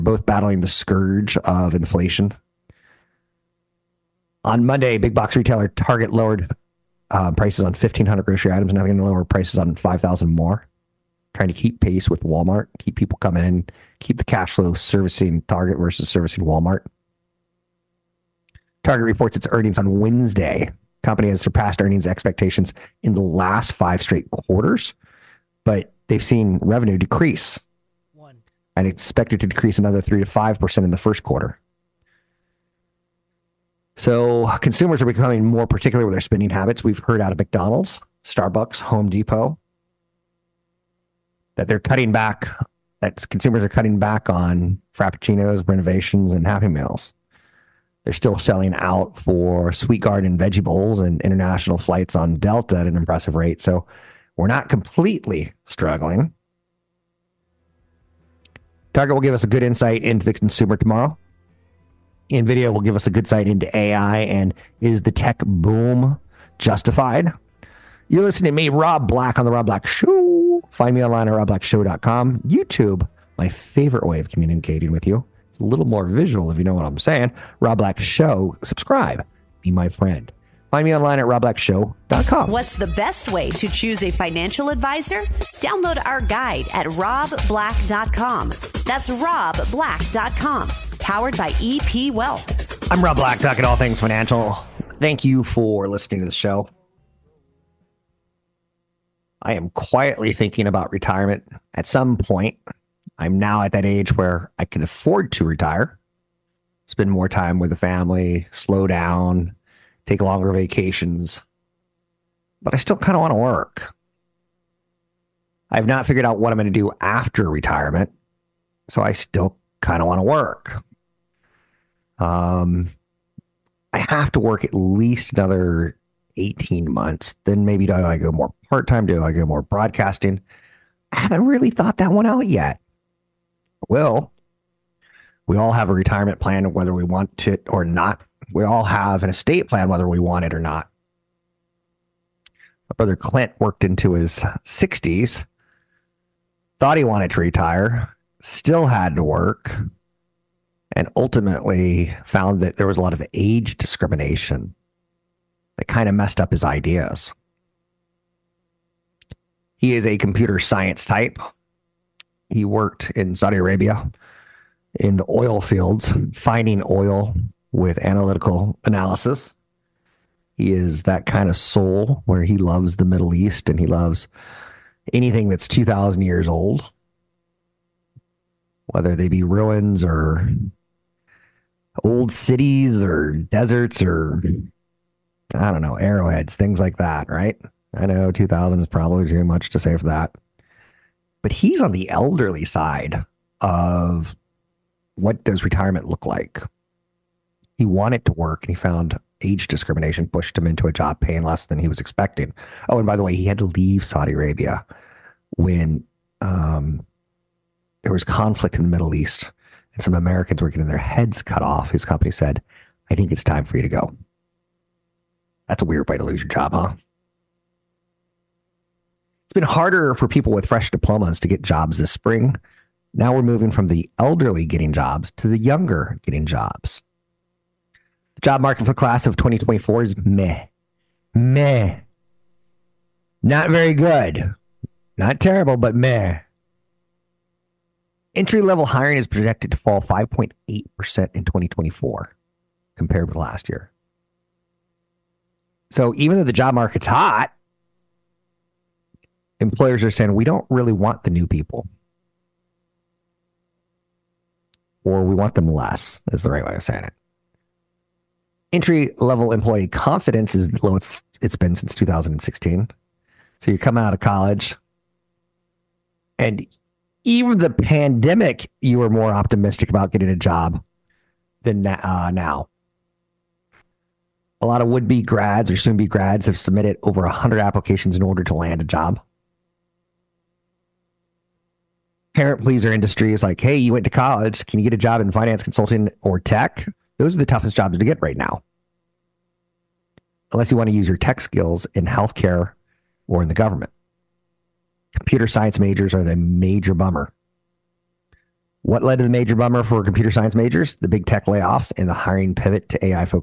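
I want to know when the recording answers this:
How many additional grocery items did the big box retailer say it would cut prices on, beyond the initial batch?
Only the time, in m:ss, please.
0:09.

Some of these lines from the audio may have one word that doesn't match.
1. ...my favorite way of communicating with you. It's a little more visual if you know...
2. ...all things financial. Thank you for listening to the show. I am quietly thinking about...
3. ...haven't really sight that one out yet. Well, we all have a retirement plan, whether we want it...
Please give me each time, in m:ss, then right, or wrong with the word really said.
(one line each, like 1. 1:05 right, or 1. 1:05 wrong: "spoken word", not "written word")
1. 1:13 right
2. 1:33 right
3. 2:11 wrong: "thought", not "sight".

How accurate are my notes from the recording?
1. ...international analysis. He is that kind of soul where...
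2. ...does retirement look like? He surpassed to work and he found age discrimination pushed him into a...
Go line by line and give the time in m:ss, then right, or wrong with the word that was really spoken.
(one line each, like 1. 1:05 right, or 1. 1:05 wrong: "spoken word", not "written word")
1. 2:48 wrong: "analytical", not "international"
2. 3:15 wrong: "wanted", not "surpassed".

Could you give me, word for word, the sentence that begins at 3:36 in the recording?
It's been harder for people with fresh diplomas to get jobs this spring.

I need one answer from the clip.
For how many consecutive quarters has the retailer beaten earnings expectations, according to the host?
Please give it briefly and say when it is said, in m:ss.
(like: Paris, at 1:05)
5, at 0:23.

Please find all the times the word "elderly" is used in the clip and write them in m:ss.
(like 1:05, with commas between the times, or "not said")
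3:12, 3:44.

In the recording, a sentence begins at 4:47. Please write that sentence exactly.
Those are the toughest jobs to get right now.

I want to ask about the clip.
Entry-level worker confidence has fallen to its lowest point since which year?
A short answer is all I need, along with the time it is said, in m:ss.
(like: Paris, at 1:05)
2016, at 4:21.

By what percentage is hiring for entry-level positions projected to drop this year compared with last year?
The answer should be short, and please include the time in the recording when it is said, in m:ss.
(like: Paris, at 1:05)
5.8%, at 3:59.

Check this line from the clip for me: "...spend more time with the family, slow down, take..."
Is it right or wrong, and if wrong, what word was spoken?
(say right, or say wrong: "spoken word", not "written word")
right.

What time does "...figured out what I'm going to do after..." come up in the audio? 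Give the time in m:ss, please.
1:56.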